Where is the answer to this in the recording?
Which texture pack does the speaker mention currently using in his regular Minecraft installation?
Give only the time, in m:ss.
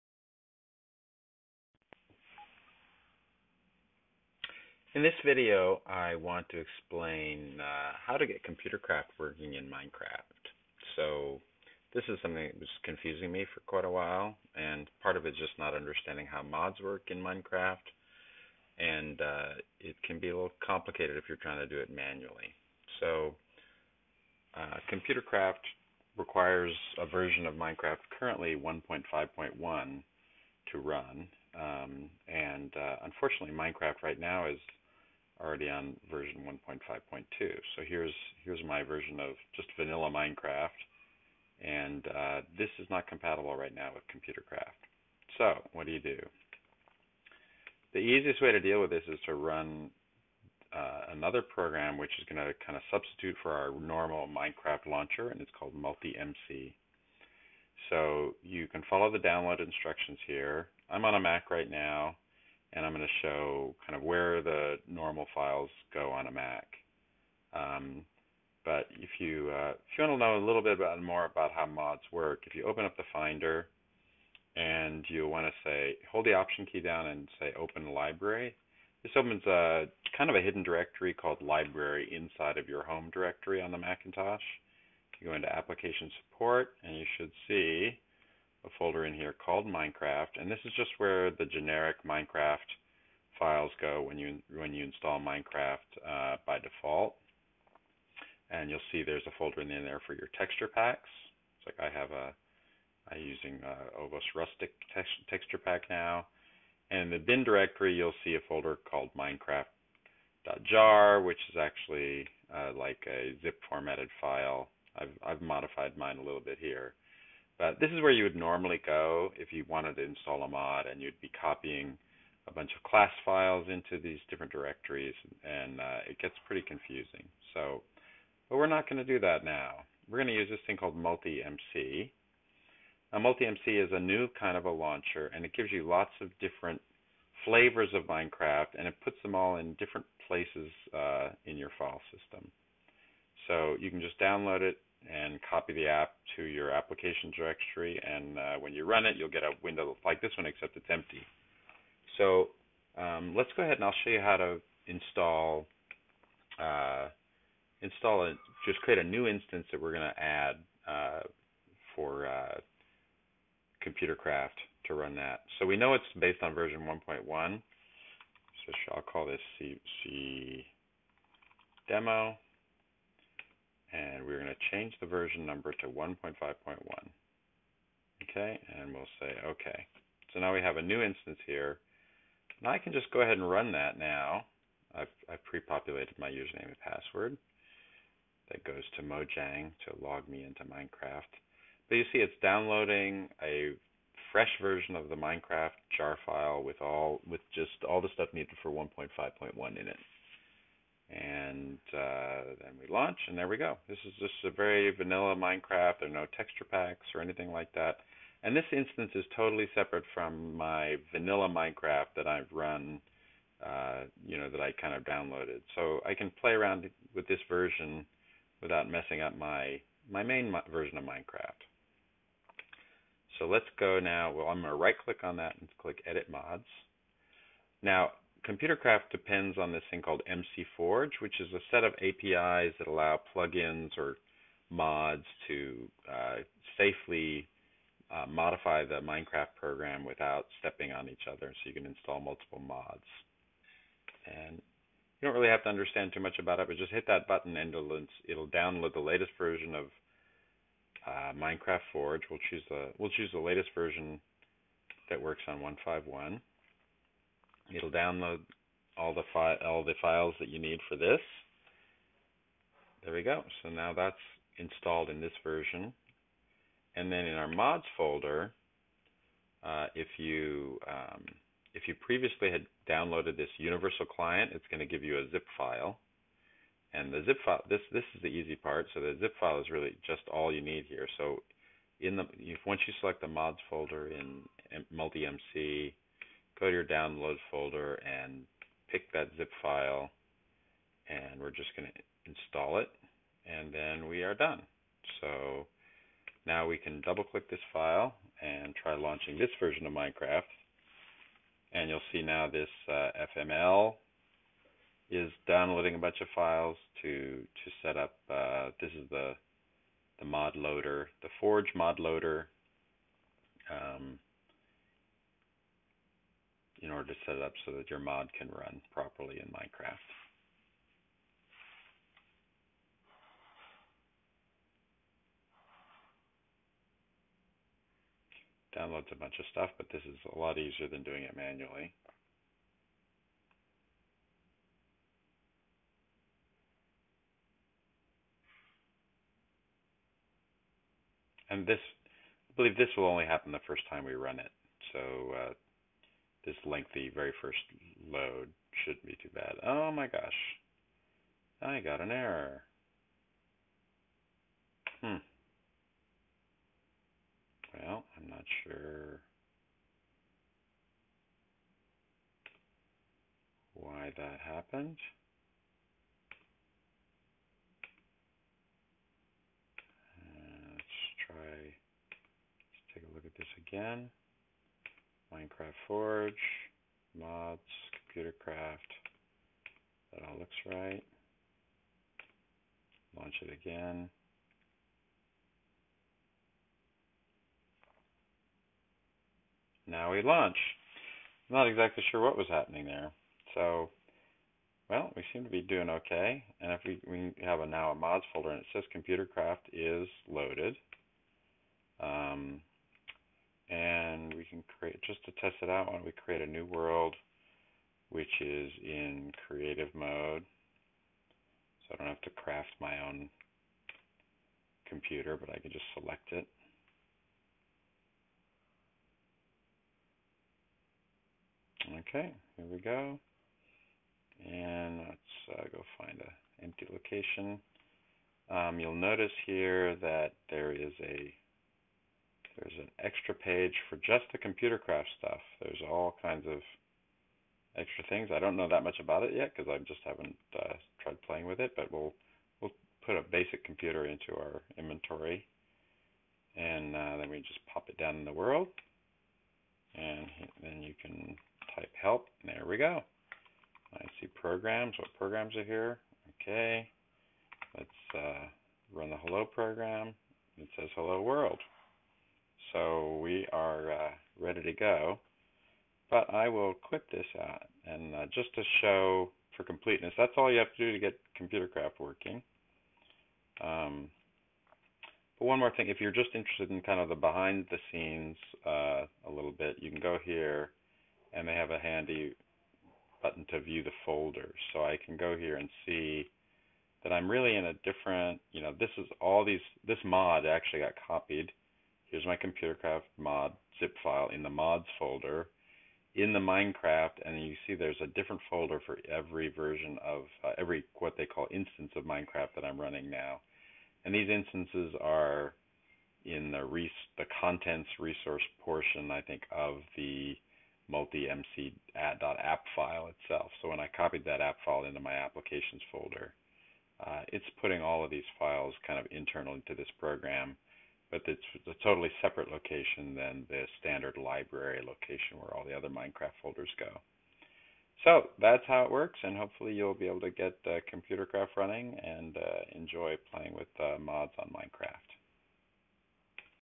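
1:43.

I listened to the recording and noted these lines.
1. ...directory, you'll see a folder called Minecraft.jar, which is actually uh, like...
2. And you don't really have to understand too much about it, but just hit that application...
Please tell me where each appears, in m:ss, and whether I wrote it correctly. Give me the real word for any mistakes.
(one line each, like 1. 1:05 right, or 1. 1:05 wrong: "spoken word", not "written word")
1. 1:47 right
2. 4:04 wrong: "button", not "application".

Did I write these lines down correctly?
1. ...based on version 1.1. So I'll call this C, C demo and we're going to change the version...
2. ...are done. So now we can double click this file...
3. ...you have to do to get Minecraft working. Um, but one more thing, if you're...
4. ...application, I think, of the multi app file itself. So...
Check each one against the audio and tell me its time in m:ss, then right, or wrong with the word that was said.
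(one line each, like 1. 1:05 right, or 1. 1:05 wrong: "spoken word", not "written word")
1. 2:46 right
2. 4:54 right
3. 7:50 wrong: "ComputerCraft", not "Minecraft"
4. 8:28 wrong: "portion", not "application".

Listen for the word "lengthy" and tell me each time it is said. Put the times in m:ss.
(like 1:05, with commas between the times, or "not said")
5:46.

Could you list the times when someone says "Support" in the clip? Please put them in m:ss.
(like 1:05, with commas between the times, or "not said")
1:26.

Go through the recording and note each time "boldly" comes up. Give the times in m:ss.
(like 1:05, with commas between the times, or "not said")
not said.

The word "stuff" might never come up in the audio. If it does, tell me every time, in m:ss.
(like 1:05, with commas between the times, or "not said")
3:18, 5:29, 7:15.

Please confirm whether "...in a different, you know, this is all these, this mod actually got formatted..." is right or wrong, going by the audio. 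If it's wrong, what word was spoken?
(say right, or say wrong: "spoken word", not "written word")
wrong: "copied", not "formatted".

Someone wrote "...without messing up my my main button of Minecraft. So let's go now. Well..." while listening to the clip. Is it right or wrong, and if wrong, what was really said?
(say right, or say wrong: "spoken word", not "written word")
wrong: "version", not "button".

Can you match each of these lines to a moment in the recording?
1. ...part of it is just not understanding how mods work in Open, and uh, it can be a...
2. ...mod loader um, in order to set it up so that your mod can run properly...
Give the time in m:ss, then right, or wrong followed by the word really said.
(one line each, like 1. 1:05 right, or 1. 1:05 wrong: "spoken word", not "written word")
1. 0:15 wrong: "Minecraft", not "Open"
2. 5:11 right.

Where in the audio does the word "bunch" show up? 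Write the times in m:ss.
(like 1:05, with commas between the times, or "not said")
2:02, 5:05, 5:29.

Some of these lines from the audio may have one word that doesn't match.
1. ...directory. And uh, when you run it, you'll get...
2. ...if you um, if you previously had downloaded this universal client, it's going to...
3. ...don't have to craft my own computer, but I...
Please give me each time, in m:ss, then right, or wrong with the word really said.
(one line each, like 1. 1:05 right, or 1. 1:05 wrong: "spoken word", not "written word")
1. 2:27 right
2. 4:29 right
3. 6:51 right.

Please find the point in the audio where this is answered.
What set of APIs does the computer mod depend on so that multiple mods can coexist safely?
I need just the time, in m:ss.
3:50.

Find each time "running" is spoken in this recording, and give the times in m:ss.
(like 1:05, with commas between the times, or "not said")
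8:22, 8:51.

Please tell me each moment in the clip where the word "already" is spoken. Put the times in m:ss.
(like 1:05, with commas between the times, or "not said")
0:35.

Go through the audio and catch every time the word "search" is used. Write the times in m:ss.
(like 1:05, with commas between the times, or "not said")
not said.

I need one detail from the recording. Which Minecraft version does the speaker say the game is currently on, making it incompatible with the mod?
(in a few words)
1.5.2.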